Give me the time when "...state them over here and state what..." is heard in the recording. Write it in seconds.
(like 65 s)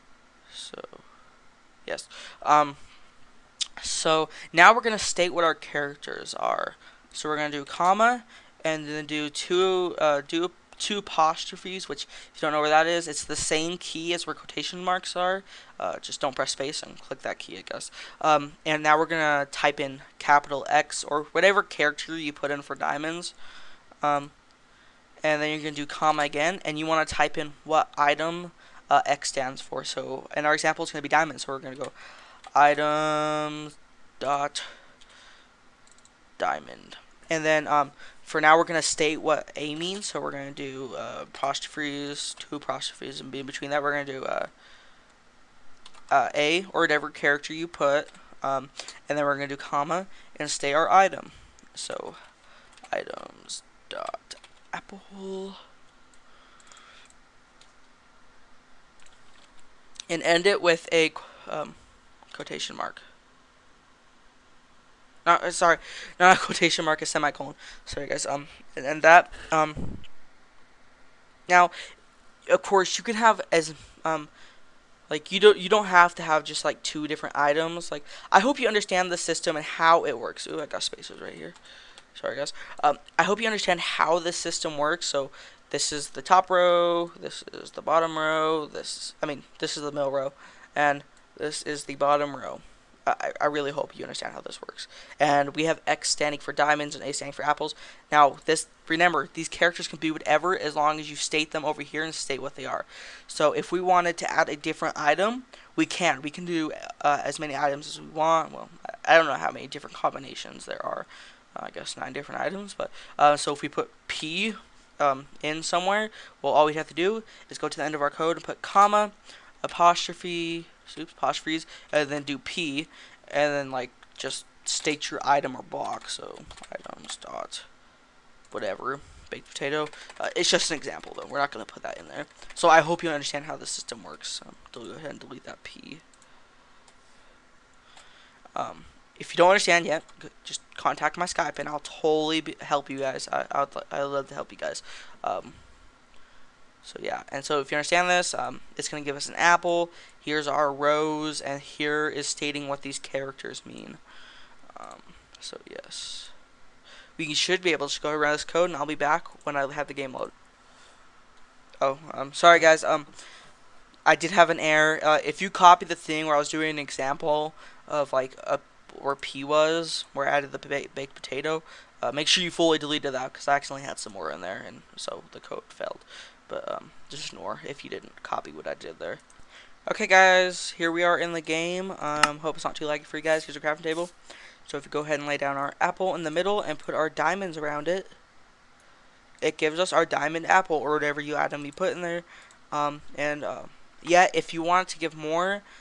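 101 s.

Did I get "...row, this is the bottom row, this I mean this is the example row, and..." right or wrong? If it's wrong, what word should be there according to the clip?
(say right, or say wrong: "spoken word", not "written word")
wrong: "middle", not "example".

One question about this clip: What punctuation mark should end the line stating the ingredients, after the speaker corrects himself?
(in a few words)
semicolon.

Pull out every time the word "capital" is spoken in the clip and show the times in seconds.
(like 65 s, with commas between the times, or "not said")
20 s.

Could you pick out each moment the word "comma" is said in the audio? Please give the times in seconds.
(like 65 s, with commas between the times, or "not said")
7 s, 25 s, 49 s, 118 s.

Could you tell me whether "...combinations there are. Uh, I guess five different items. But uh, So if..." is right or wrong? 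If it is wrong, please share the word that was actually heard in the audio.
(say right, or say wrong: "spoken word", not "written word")
wrong: "nine", not "five".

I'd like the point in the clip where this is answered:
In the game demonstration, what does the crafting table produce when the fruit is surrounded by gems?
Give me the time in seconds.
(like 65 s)
190 s.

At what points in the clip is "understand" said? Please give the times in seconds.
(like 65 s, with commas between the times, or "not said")
78 s, 83 s, 94 s, 133 s, 139 s, 147 s.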